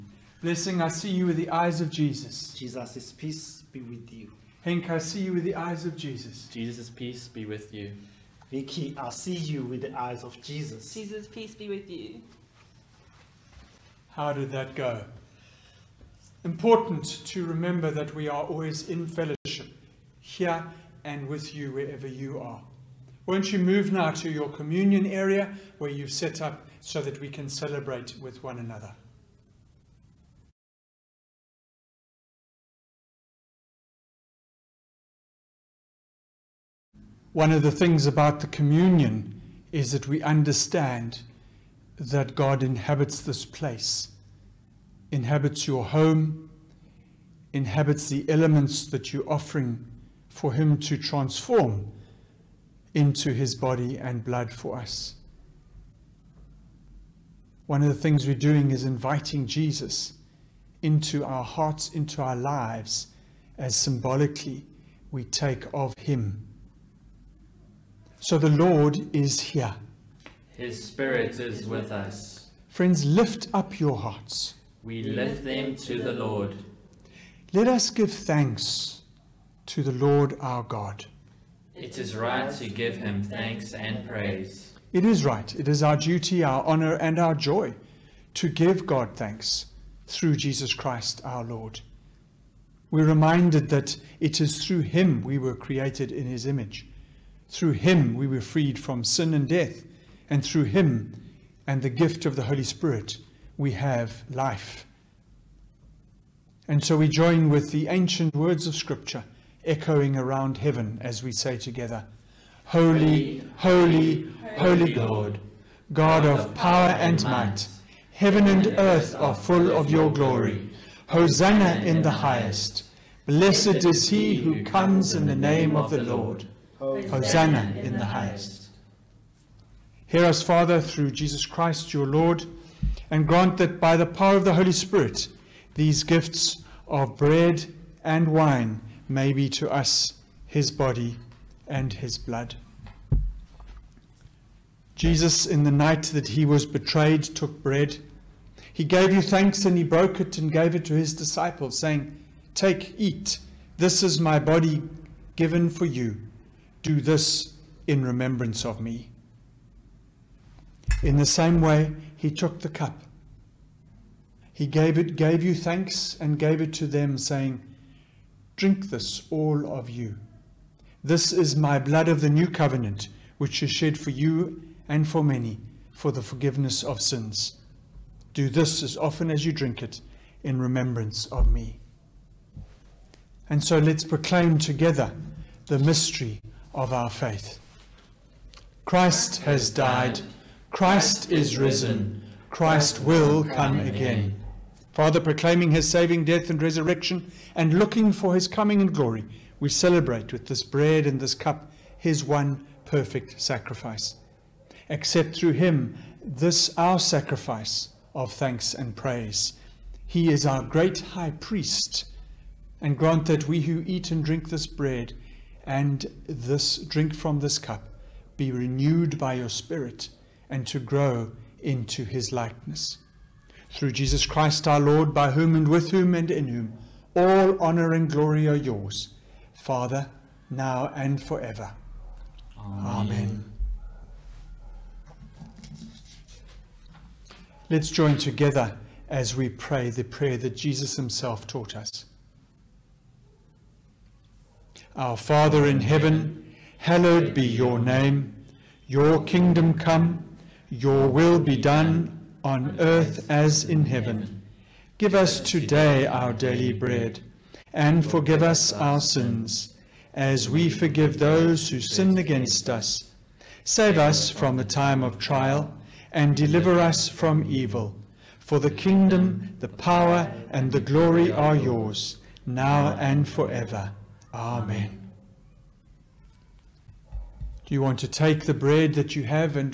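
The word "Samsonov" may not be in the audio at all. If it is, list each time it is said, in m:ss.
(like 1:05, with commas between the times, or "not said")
not said.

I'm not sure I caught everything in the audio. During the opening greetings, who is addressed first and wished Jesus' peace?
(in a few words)
Blessing.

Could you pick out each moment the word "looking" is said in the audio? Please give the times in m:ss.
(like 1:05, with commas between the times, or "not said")
3:17.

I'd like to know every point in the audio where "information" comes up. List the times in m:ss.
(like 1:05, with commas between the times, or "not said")
not said.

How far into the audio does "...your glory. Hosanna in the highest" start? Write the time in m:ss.
1:59.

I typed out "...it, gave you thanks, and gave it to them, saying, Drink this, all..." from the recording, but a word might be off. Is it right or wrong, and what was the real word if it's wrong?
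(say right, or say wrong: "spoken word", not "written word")
right.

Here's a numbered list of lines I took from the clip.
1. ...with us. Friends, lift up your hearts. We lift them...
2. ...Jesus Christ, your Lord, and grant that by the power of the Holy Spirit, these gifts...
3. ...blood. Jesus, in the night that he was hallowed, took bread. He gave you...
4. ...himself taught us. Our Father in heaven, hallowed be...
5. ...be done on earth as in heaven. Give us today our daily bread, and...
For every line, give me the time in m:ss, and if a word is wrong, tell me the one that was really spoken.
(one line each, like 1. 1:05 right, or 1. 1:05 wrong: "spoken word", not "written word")
1. 1:11 right
2. 2:11 right
3. 2:22 wrong: "betrayed", not "hallowed"
4. 4:00 right
5. 4:11 right.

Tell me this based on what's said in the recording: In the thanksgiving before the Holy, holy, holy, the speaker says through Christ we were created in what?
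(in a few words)
his image.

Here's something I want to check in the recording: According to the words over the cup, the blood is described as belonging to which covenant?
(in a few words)
the new covenant.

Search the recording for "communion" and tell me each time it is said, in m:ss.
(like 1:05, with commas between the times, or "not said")
0:24, 0:38.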